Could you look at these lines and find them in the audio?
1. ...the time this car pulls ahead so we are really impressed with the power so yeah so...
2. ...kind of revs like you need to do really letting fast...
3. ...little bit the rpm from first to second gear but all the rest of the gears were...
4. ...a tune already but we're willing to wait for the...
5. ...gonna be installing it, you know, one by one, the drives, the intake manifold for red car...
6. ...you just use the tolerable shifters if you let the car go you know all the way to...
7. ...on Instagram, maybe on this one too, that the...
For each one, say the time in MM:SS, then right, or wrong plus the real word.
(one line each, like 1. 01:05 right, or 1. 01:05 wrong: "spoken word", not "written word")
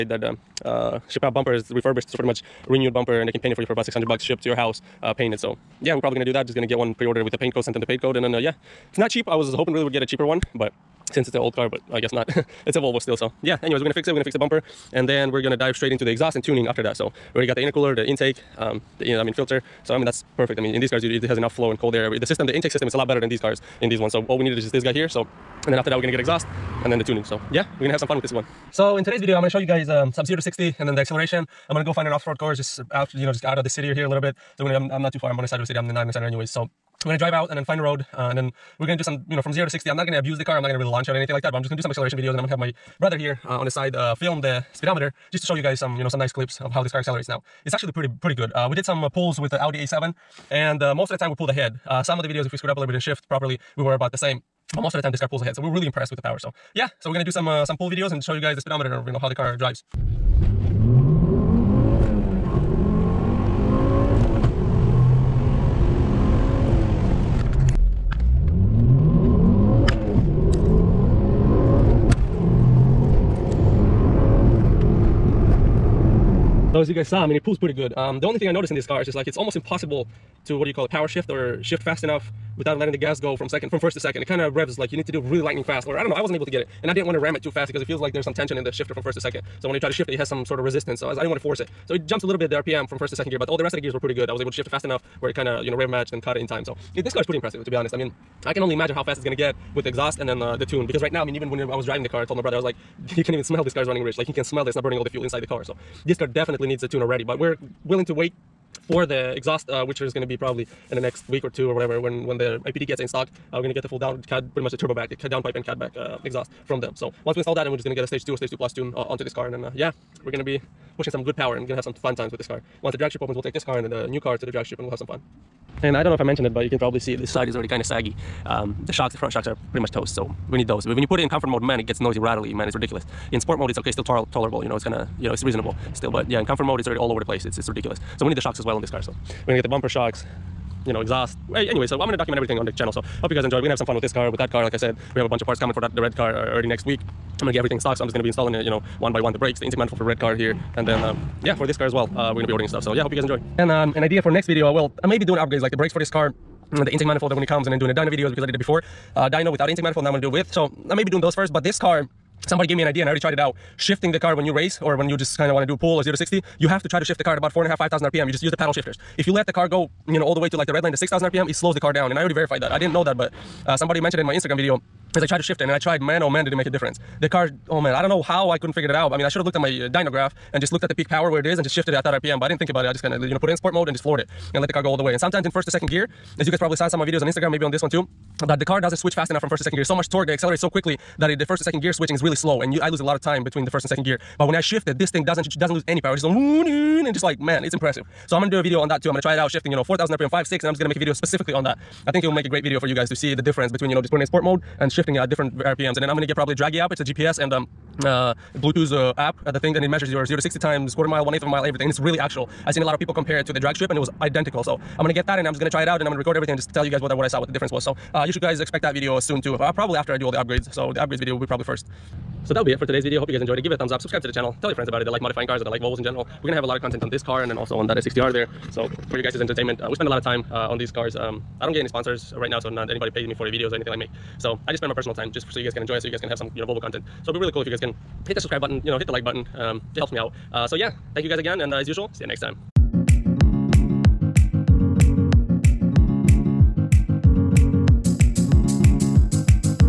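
1. 00:54 right
2. 01:24 wrong: "lightning", not "letting"
3. 01:32 right
4. 01:46 right
5. 02:28 wrong: "brakes", not "drives"
6. 02:48 wrong: "paddle", not "tolerable"
7. 03:07 right.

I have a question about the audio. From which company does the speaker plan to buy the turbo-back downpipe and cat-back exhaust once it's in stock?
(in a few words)
IPD.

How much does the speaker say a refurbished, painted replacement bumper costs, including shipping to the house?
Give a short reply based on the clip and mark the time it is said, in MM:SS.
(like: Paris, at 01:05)
$600, at 00:03.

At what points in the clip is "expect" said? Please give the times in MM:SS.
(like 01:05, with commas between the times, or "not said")
03:38.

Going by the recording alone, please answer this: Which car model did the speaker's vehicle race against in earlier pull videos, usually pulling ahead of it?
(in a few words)
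Audi A7.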